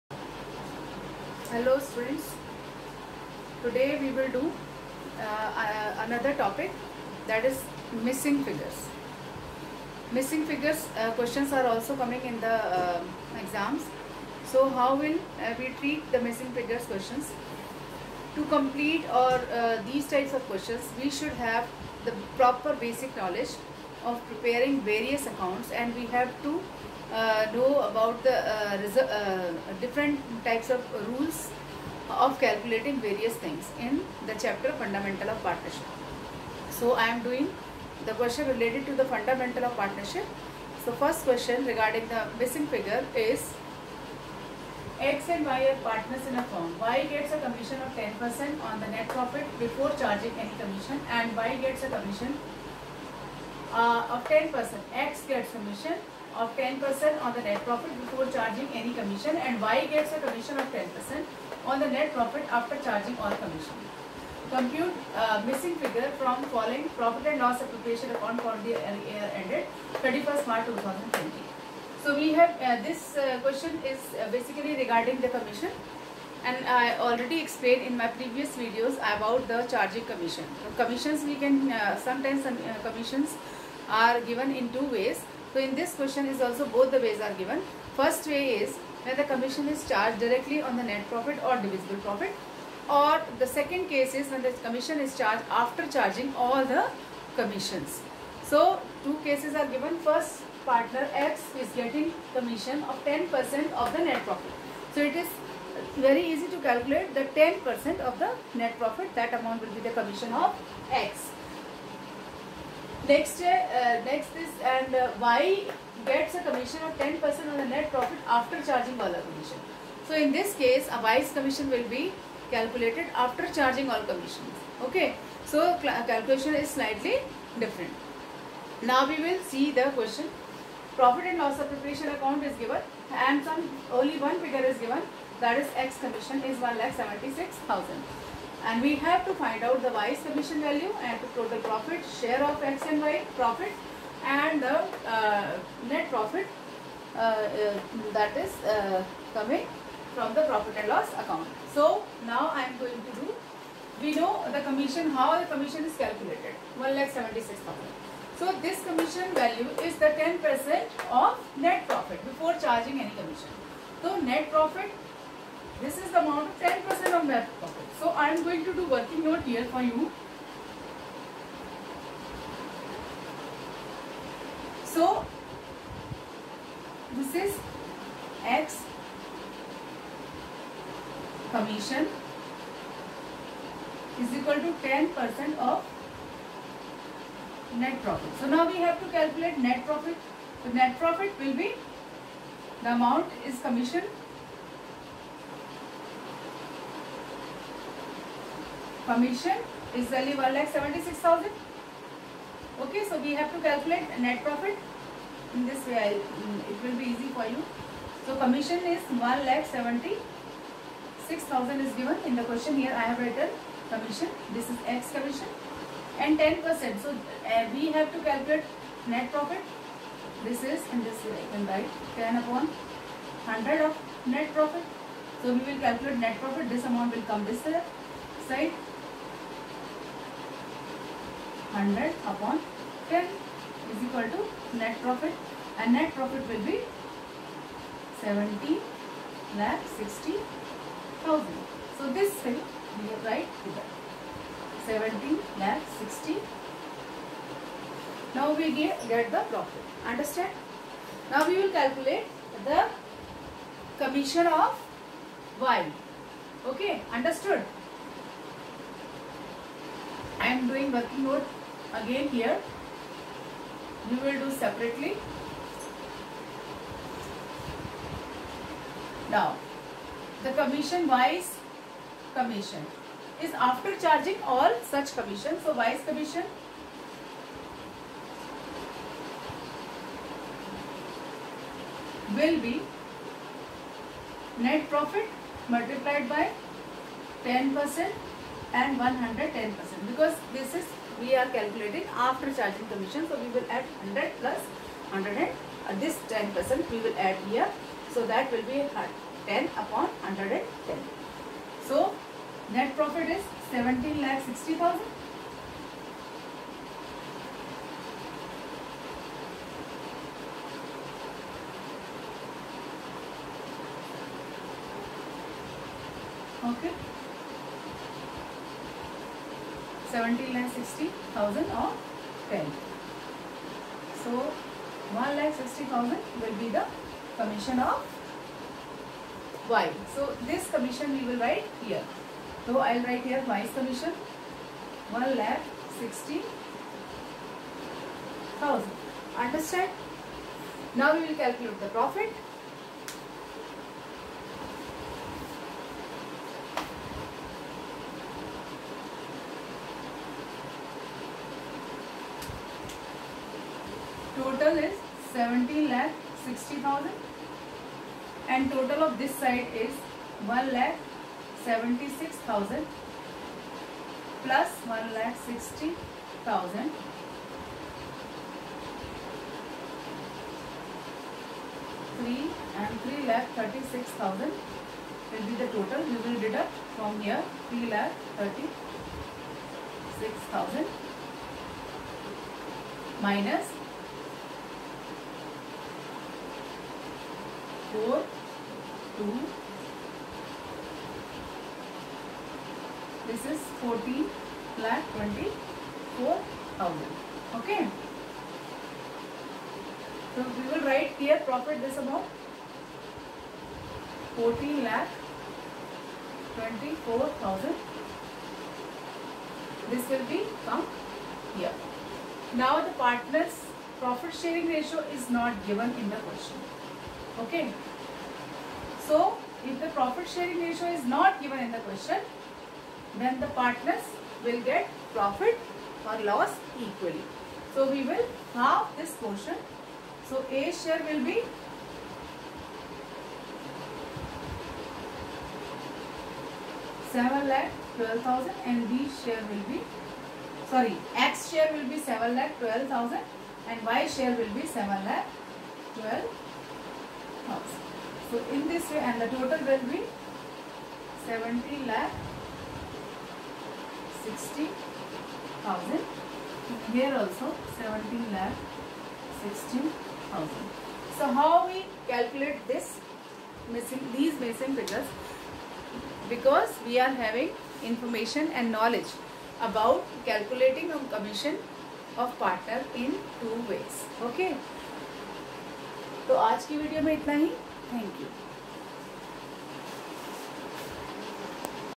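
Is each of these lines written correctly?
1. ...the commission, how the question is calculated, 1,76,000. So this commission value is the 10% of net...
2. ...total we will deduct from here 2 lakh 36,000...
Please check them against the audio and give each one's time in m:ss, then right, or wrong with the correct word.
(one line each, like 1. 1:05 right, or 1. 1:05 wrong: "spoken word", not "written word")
1. 2:34 wrong: "commission", not "question"
2. 6:15 wrong: "3", not "2".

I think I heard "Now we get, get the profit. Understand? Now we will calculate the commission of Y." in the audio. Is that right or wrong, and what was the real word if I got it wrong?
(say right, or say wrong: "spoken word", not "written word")
right.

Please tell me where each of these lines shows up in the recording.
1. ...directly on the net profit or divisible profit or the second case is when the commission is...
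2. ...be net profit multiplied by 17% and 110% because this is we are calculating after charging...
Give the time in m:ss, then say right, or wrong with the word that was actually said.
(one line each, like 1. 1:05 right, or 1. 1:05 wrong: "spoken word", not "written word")
1. 1:30 right
2. 4:42 wrong: "10", not "17".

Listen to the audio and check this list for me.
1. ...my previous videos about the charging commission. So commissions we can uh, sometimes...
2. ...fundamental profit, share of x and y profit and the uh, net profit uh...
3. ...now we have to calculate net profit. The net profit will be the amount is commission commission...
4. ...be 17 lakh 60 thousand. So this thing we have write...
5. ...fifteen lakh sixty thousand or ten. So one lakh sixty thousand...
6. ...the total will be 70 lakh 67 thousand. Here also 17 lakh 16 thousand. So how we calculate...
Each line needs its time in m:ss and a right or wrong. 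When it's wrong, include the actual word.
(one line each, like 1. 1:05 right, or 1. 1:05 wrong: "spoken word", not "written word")
1. 1:17 right
2. 2:21 wrong: "total", not "fundamental"
3. 3:08 right
4. 3:56 right
5. 5:20 wrong: "seventeen", not "fifteen"
6. 7:29 wrong: "60", not "67".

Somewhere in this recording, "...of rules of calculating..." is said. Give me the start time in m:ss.
0:30.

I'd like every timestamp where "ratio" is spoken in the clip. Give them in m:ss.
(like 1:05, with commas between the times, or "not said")
6:54, 7:00.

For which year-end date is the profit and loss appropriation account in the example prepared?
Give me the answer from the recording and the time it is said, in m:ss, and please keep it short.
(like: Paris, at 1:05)
31st March 2020, at 1:10.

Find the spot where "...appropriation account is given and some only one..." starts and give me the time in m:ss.
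2:11.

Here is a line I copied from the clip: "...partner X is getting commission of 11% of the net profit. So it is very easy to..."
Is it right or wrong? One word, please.
wrong.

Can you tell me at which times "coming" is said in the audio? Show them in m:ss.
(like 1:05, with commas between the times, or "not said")
0:11, 2:29.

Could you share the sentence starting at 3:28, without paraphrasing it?
So commission is one lakh seventy-six thousand is given.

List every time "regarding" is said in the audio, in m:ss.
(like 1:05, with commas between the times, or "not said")
0:41, 1:14.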